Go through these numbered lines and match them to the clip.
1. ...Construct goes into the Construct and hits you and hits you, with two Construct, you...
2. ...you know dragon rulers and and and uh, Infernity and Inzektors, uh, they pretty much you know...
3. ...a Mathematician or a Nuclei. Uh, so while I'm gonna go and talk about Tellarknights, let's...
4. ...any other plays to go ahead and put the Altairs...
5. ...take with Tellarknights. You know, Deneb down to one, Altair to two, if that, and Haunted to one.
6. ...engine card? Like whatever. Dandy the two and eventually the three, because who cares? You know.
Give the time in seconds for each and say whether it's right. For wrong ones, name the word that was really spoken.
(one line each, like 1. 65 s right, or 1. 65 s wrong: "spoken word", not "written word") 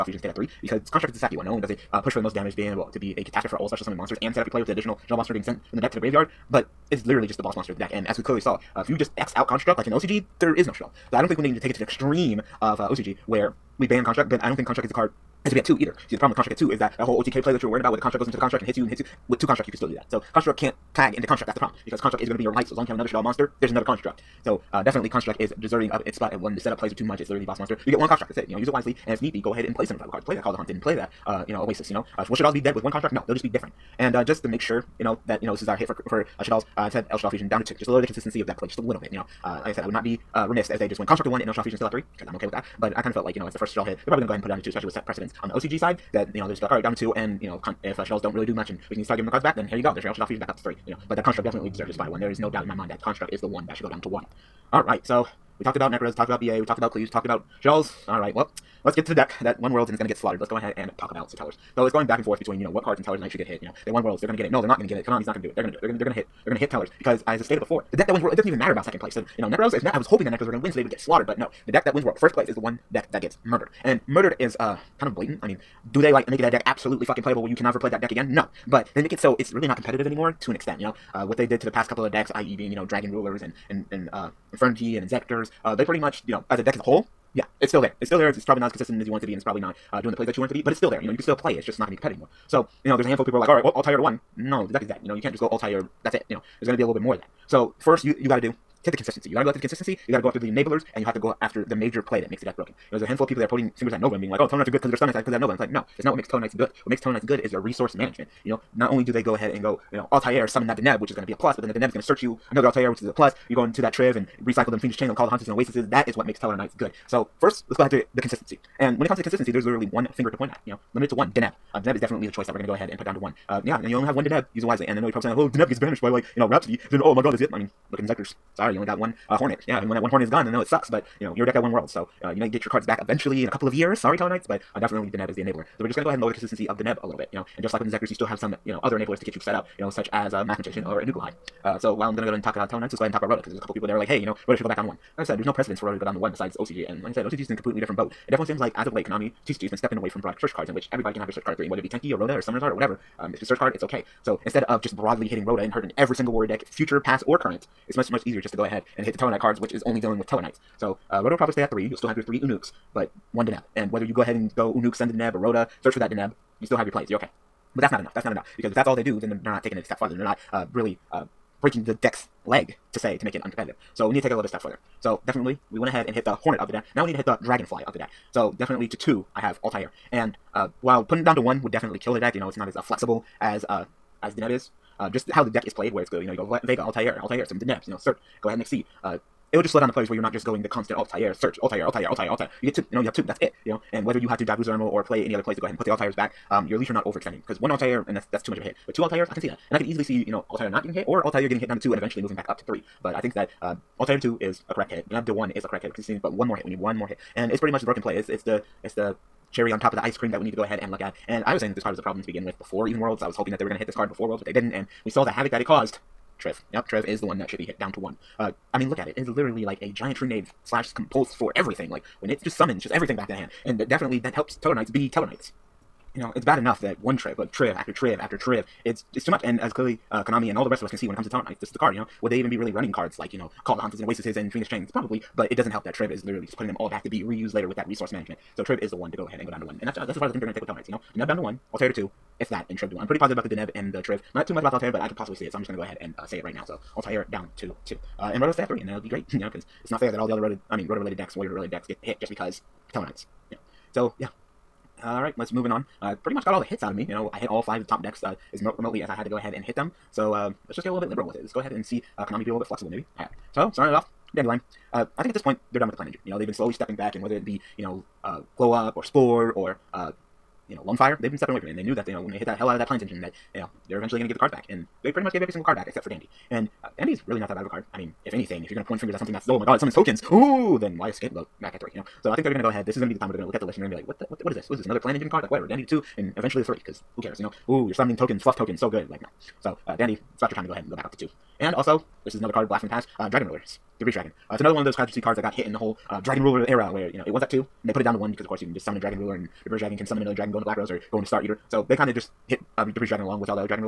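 1. 17 s right
2. 82 s right
3. 140 s right
4. 195 s right
5. 240 s wrong: "Trib", not "Haunted"
6. 285 s right.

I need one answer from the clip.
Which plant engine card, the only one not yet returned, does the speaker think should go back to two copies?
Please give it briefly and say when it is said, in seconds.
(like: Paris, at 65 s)
Dandelion, at 263 s.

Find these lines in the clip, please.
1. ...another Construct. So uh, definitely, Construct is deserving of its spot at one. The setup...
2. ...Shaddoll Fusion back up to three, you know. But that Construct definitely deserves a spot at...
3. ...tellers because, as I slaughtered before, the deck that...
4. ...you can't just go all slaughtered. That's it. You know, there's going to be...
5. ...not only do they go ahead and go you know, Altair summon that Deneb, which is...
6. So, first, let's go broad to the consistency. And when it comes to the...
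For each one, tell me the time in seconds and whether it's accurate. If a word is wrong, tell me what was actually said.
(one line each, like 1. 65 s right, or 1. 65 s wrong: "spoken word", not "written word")
1. 23 s right
2. 50 s right
3. 66 s wrong: "stated", not "slaughtered"
4. 95 s wrong: "tired", not "slaughtered"
5. 108 s right
6. 117 s wrong: "ahead", not "broad".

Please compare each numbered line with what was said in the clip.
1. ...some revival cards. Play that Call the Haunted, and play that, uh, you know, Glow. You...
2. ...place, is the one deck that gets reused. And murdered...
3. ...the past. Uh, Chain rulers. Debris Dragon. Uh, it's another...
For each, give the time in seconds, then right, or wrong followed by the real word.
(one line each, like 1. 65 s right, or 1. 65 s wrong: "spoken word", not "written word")
1. 29 s wrong: "Oasis", not "Glow"
2. 72 s wrong: "murdered", not "reused"
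3. 292 s wrong: "Dragon", not "Chain".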